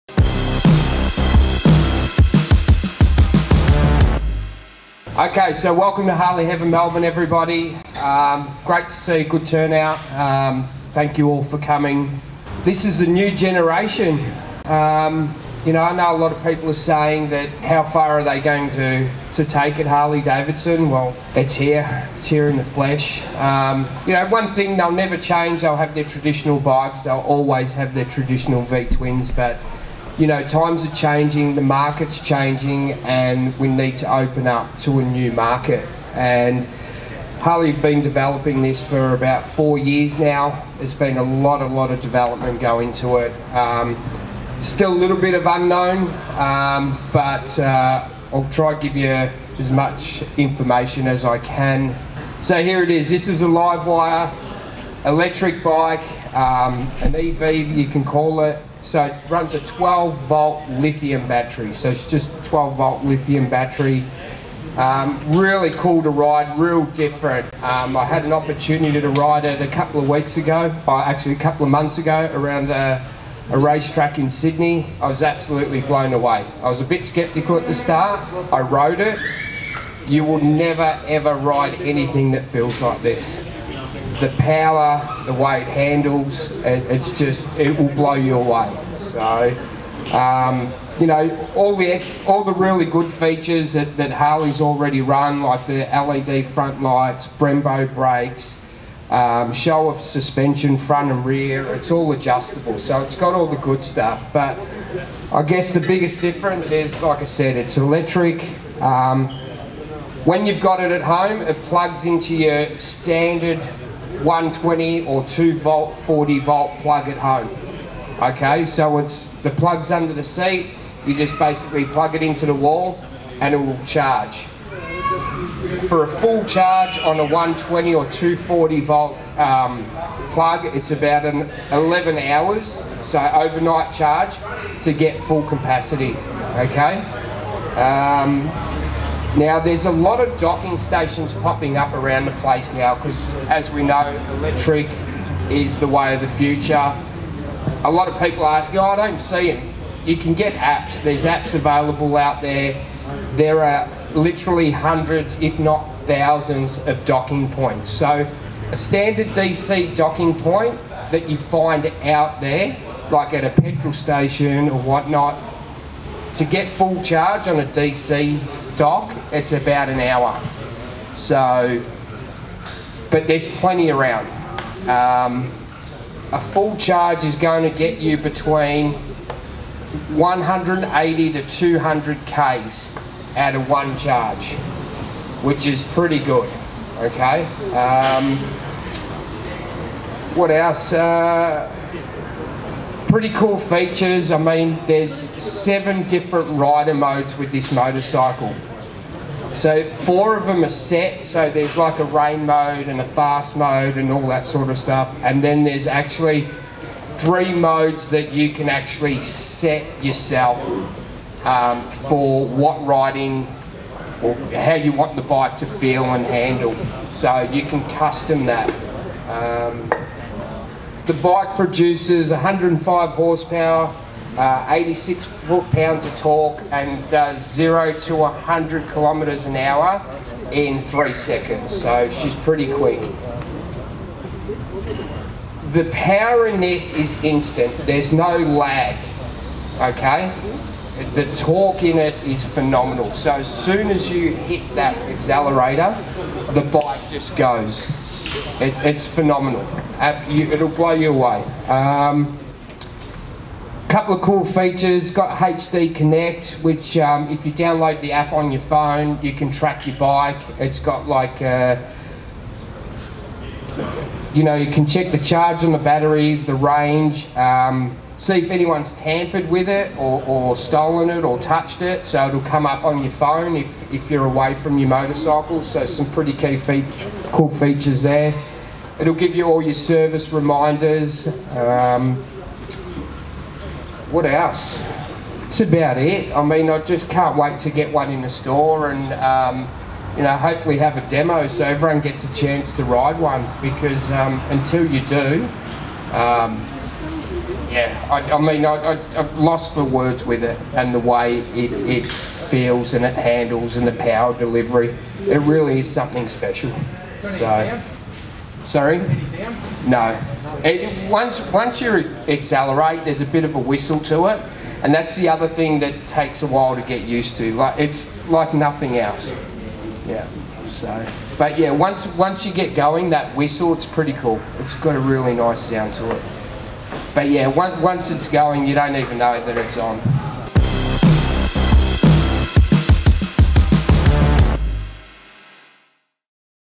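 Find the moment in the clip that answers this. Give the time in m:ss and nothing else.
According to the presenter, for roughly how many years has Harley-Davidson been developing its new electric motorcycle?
0:39.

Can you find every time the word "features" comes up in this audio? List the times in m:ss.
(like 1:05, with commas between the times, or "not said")
1:33, 3:13, 4:14, 4:37.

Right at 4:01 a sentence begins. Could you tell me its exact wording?
The torque in it is phenomenal, so as soon as you hit that accelerator, the bike just goes.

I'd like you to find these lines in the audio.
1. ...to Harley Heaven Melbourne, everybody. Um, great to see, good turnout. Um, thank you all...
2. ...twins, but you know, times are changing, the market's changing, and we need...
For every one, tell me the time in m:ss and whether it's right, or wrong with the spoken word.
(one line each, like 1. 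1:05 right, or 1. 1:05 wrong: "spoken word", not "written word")
1. 0:06 right
2. 0:28 right.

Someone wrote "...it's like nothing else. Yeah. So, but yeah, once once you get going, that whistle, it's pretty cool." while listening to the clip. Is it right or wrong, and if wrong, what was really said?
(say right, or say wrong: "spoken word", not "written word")
right.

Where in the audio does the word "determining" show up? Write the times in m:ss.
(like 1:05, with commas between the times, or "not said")
not said.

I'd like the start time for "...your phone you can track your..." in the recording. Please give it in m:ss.
4:18.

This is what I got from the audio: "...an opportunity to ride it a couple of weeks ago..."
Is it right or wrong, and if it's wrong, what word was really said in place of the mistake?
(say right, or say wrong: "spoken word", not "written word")
right.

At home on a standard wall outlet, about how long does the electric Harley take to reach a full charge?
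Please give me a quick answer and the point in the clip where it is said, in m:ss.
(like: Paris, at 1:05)
11 hours, at 2:10.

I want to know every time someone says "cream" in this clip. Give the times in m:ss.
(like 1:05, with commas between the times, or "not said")
not said.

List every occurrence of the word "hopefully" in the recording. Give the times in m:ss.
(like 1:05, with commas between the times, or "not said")
4:50.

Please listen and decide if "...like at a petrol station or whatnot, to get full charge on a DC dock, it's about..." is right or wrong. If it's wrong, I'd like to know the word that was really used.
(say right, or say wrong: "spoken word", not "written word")
right.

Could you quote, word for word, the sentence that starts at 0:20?
Well, it's here, it's here in the flesh.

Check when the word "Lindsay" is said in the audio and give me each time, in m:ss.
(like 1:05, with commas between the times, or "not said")
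not said.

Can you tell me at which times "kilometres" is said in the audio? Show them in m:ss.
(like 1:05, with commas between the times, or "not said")
3:48.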